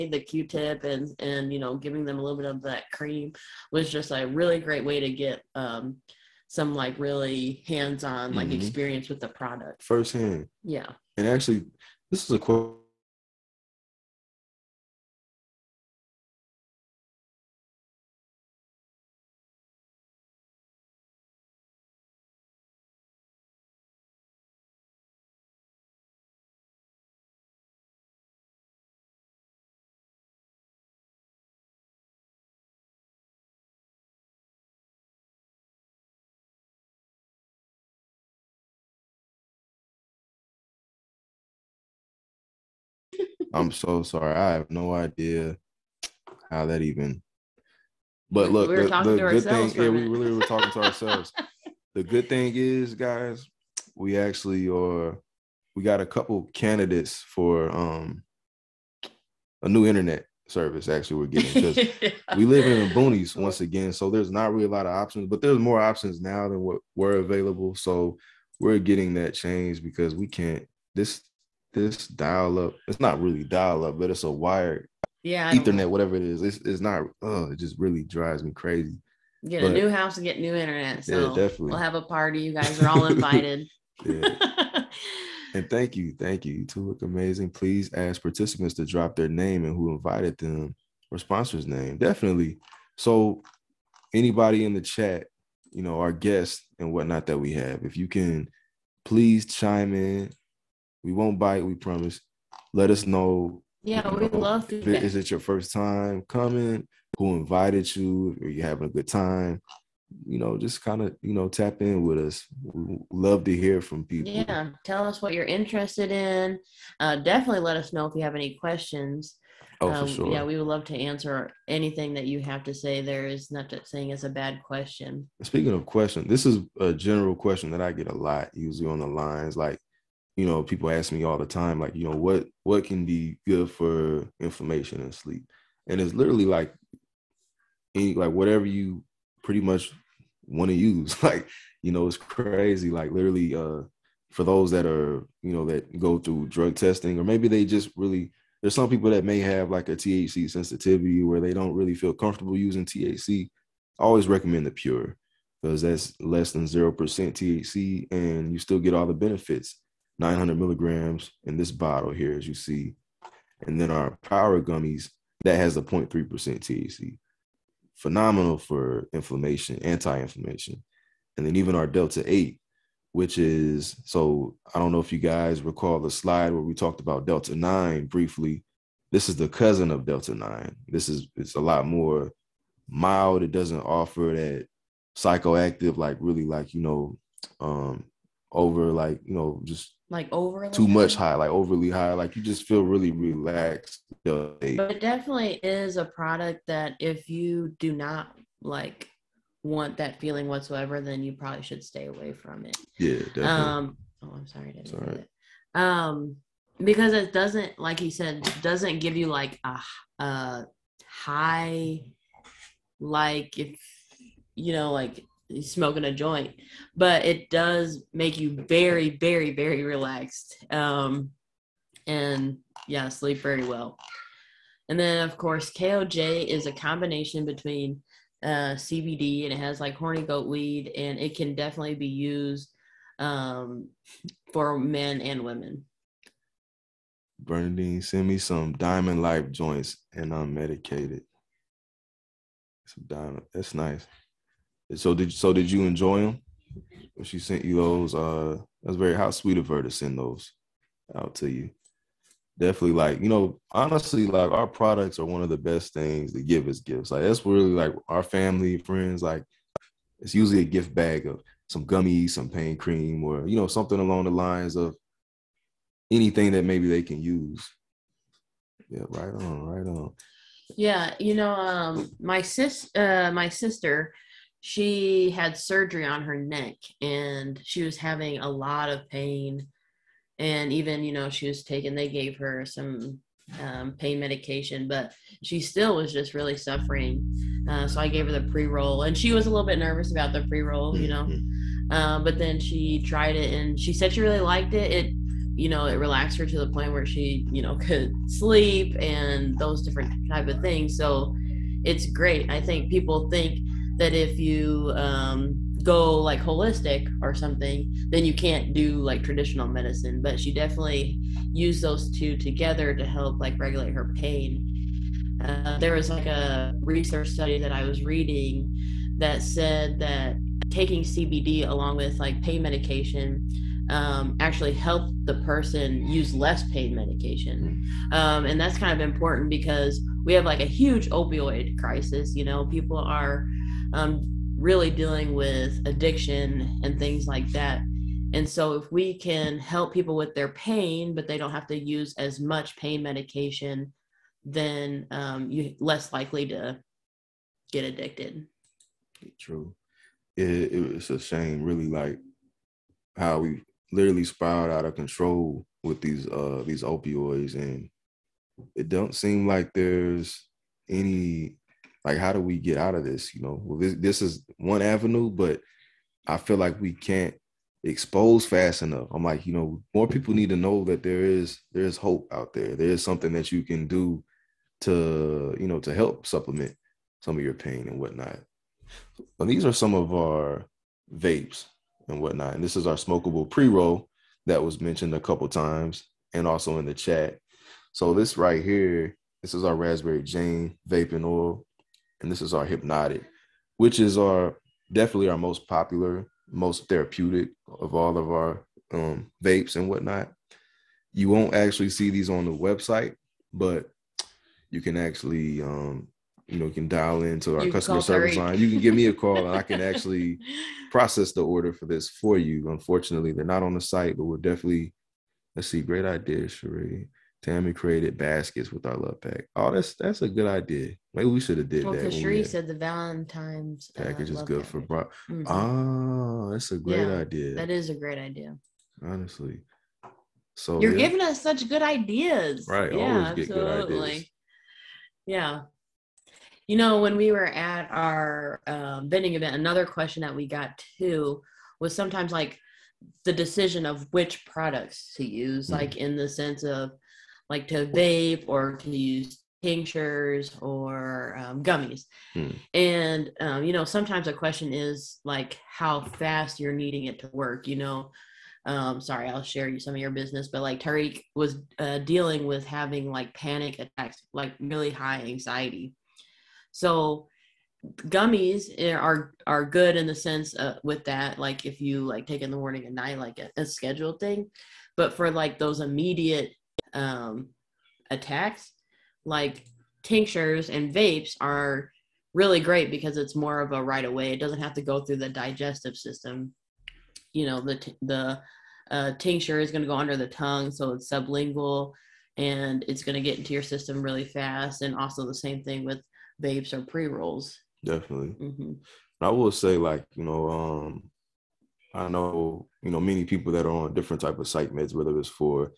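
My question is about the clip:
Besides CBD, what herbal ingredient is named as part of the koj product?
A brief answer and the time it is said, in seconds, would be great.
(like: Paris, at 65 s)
horny goat weed, at 229 s.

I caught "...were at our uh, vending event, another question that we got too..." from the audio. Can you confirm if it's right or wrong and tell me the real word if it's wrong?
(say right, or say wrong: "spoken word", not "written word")
right.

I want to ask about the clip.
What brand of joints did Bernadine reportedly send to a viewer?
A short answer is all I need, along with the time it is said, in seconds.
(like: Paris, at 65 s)
Diamond Life, at 238 s.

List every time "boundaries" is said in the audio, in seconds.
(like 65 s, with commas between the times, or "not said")
not said.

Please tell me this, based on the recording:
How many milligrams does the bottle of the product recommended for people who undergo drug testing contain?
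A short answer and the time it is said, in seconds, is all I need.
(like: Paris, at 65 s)
900, at 160 s.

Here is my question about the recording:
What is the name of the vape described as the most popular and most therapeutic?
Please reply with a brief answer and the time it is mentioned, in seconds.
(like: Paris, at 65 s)
hypnotic, at 392 s.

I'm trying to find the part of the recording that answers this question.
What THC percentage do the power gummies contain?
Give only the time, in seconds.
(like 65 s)
165 s.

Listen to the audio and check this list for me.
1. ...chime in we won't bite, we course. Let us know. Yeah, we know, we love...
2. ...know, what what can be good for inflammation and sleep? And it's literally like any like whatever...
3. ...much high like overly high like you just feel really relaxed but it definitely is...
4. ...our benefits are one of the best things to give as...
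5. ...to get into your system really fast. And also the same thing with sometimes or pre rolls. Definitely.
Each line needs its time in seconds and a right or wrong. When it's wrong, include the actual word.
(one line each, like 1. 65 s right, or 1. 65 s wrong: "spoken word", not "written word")
1. 99 s wrong: "promise", not "course"
2. 132 s right
3. 190 s right
4. 254 s wrong: "products", not "benefits"
5. 493 s wrong: "vapes", not "sometimes".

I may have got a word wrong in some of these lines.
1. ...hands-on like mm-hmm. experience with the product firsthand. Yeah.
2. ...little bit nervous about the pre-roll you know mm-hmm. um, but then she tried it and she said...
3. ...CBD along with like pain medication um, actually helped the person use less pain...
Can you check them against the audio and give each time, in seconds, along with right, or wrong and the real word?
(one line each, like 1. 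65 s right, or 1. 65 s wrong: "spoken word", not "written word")
1. 7 s right
2. 289 s right
3. 321 s right.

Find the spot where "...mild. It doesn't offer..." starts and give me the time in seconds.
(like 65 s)
182 s.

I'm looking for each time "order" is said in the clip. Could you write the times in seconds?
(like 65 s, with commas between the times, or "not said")
411 s.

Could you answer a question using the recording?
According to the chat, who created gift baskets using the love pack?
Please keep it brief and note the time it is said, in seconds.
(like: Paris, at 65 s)
Tammy, at 417 s.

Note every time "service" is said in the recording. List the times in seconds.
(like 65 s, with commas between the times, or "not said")
60 s, 408 s.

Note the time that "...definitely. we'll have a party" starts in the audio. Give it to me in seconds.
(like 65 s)
81 s.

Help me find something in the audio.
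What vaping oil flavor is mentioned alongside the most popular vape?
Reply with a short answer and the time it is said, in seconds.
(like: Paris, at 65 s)
raspberry jane, at 389 s.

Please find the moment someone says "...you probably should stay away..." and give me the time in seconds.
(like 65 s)
201 s.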